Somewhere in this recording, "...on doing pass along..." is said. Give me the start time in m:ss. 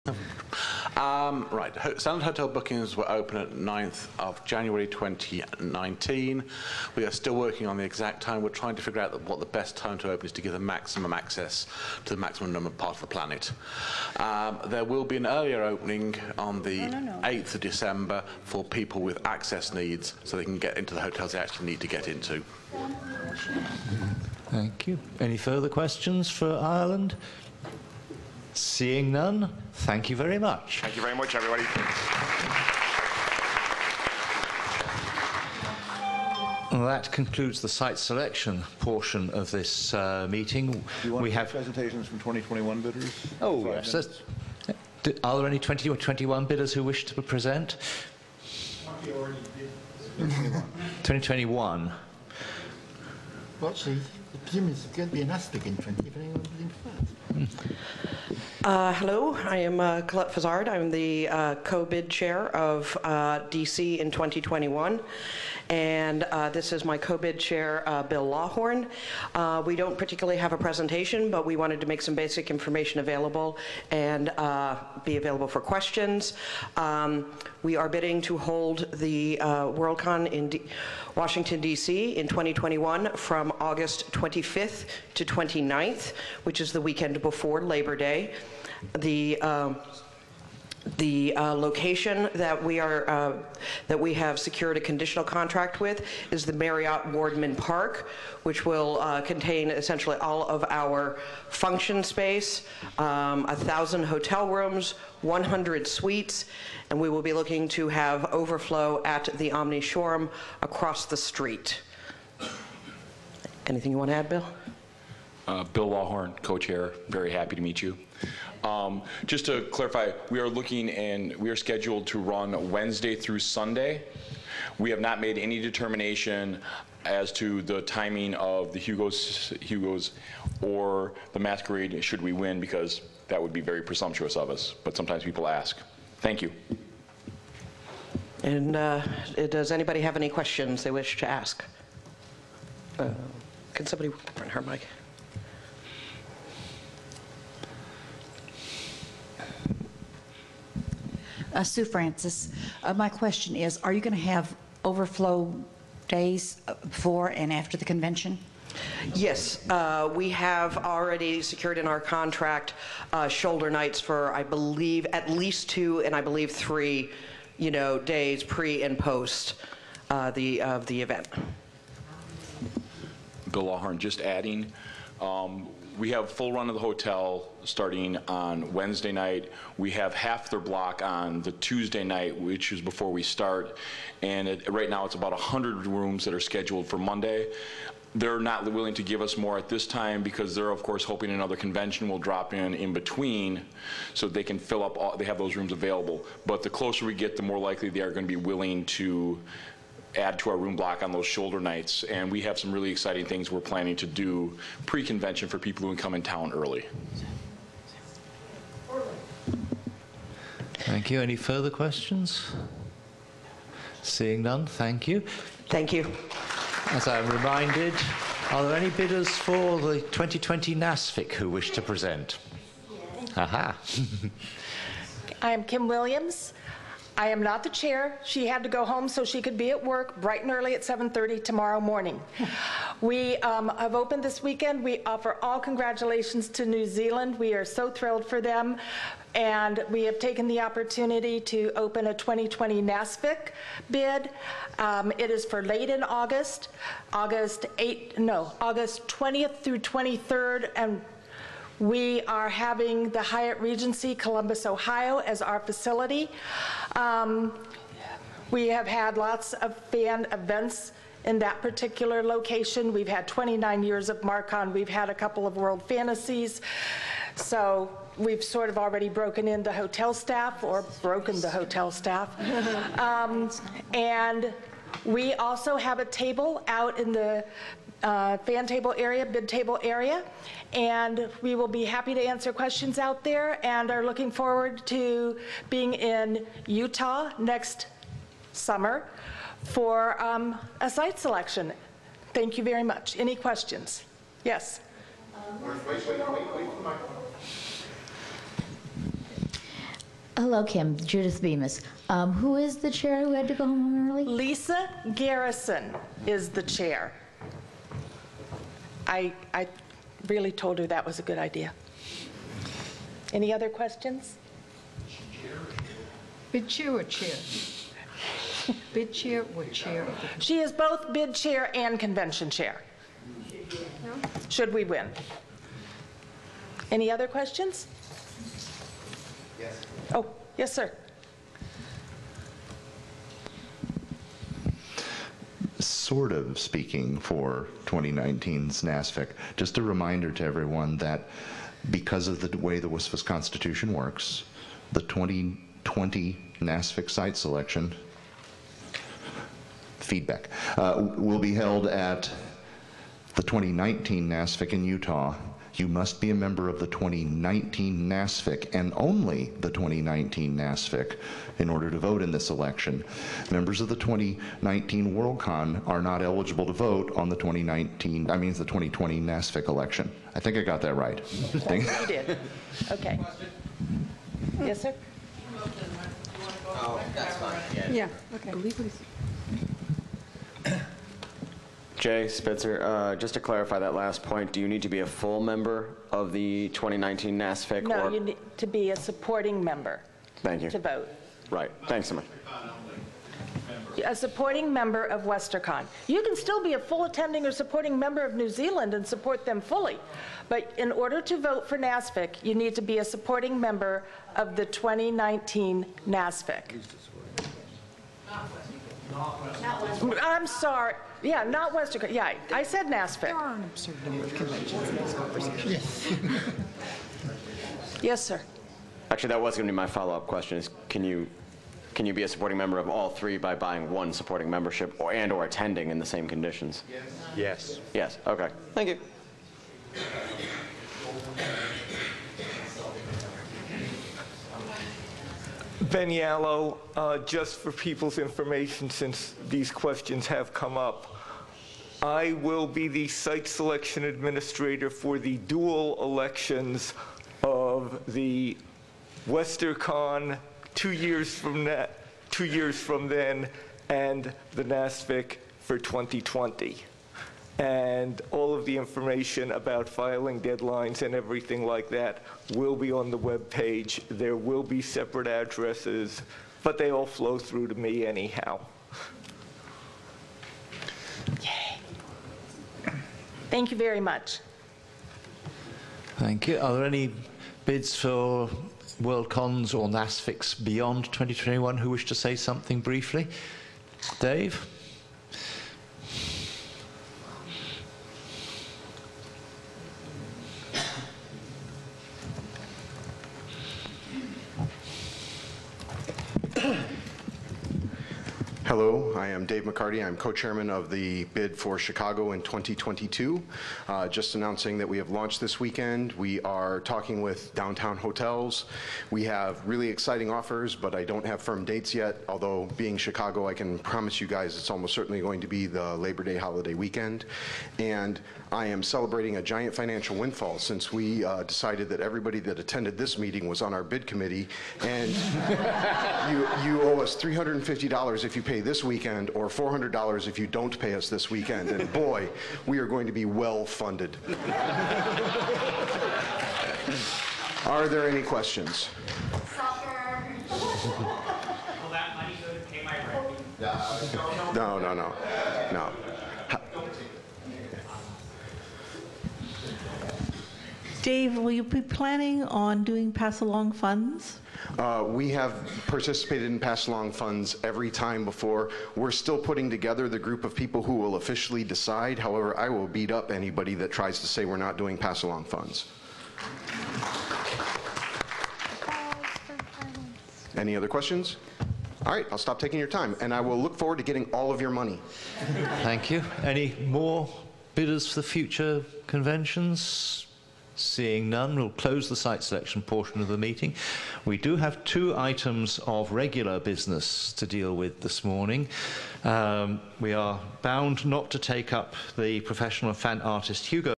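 9:12.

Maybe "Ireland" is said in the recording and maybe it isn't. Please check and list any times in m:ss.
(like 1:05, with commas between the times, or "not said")
0:26.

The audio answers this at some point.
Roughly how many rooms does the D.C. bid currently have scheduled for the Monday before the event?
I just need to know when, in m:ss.
3:05.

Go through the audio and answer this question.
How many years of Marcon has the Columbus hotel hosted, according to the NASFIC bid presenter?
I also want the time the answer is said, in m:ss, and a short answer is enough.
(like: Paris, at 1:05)
29, at 4:23.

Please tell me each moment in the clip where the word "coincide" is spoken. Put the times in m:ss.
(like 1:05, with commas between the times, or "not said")
not said.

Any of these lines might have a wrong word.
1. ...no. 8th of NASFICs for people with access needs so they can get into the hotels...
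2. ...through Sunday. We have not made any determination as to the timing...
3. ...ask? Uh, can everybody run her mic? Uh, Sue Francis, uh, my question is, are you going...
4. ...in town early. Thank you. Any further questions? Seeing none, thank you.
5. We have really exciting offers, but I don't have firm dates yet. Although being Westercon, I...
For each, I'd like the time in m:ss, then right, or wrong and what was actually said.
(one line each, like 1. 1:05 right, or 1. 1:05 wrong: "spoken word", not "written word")
1. 0:16 wrong: "December", not "NASFICs"
2. 2:03 right
3. 2:21 wrong: "somebody", not "everybody"
4. 3:26 right
5. 8:29 wrong: "Chicago", not "Westercon".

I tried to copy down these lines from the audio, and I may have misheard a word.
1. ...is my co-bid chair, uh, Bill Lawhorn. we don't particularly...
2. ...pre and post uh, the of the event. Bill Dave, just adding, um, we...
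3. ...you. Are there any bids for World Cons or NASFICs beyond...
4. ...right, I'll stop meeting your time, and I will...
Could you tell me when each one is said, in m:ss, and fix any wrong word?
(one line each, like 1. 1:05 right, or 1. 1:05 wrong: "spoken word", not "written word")
1. 1:06 right
2. 2:48 wrong: "Lawhorn", not "Dave"
3. 7:56 right
4. 9:32 wrong: "taking", not "meeting".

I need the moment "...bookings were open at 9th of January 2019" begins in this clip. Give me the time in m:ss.
0:02.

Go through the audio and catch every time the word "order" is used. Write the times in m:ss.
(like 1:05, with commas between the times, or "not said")
6:01, 6:40.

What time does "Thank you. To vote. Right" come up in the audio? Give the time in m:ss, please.
6:30.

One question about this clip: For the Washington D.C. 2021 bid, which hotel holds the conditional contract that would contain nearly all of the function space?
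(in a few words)
Marriott Wardman Park.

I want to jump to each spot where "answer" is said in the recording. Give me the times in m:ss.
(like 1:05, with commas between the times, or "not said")
4:42.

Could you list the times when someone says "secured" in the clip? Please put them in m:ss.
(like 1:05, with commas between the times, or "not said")
1:34, 2:41.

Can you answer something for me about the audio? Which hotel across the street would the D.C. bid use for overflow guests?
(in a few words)
Omni Shoreham.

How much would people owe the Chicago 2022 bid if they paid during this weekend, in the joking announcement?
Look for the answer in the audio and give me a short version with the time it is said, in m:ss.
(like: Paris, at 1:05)
$350, at 8:47.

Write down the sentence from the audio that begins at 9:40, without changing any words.
Seeing none, we'll close the site selection portion of the meeting.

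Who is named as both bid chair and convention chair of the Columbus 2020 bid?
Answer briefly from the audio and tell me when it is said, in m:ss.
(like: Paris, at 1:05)
Lisa Garrison, at 5:04.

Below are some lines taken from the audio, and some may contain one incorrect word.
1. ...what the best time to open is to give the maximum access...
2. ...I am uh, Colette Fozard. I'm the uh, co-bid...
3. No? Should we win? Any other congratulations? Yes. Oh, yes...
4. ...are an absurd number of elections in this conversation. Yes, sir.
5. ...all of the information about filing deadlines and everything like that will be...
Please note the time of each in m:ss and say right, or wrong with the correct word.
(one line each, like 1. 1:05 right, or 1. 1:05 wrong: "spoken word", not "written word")
1. 0:09 right
2. 0:59 right
3. 5:24 wrong: "questions", not "congratulations"
4. 6:53 wrong: "conventions", not "elections"
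5. 7:38 right.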